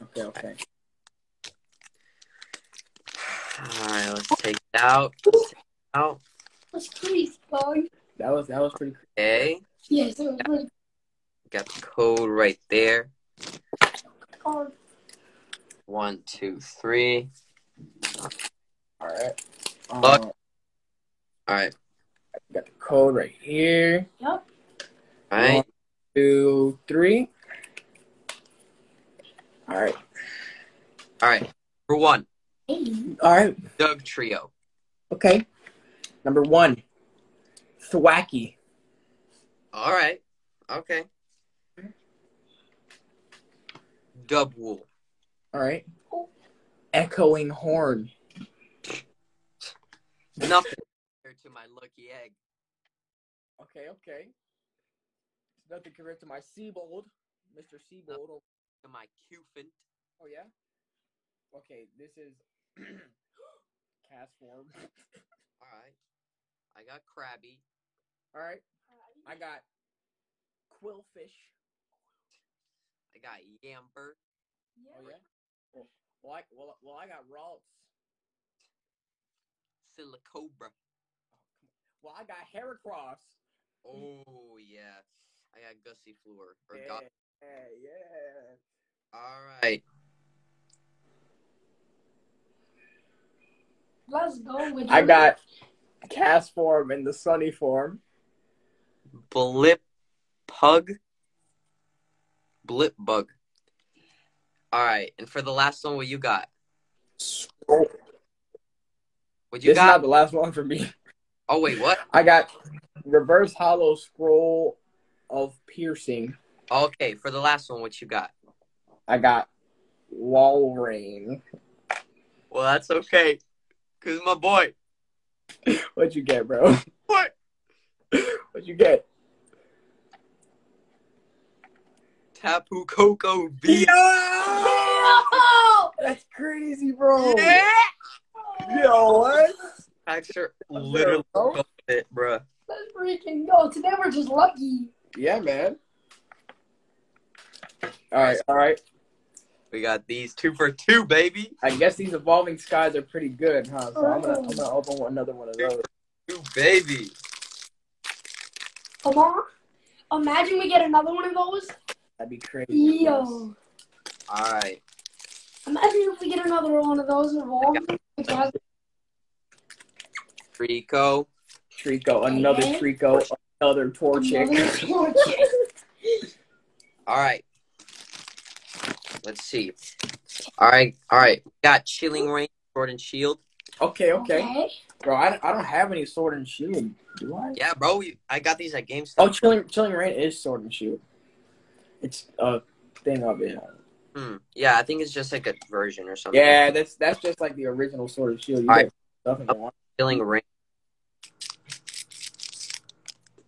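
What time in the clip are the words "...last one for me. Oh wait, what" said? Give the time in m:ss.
1:50.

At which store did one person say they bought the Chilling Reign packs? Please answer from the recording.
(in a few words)
GameStop.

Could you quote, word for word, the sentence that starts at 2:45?
Imagine if we get another one of those evolving.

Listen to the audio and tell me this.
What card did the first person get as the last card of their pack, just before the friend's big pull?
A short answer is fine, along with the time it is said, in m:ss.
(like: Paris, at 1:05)
Walrein, at 2:00.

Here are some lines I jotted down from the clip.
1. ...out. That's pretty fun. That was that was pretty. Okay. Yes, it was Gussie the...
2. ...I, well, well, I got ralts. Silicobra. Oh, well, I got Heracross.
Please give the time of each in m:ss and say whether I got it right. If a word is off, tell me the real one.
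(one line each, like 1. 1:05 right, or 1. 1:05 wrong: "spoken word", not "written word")
1. 0:05 wrong: "Got", not "Gussie"
2. 1:16 right.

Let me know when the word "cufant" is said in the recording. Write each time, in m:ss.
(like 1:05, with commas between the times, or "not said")
0:59.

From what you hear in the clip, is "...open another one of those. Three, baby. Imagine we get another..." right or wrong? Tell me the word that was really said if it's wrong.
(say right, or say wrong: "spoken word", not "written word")
wrong: "Two", not "Three".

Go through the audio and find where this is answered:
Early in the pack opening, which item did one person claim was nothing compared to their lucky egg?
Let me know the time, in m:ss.
0:46.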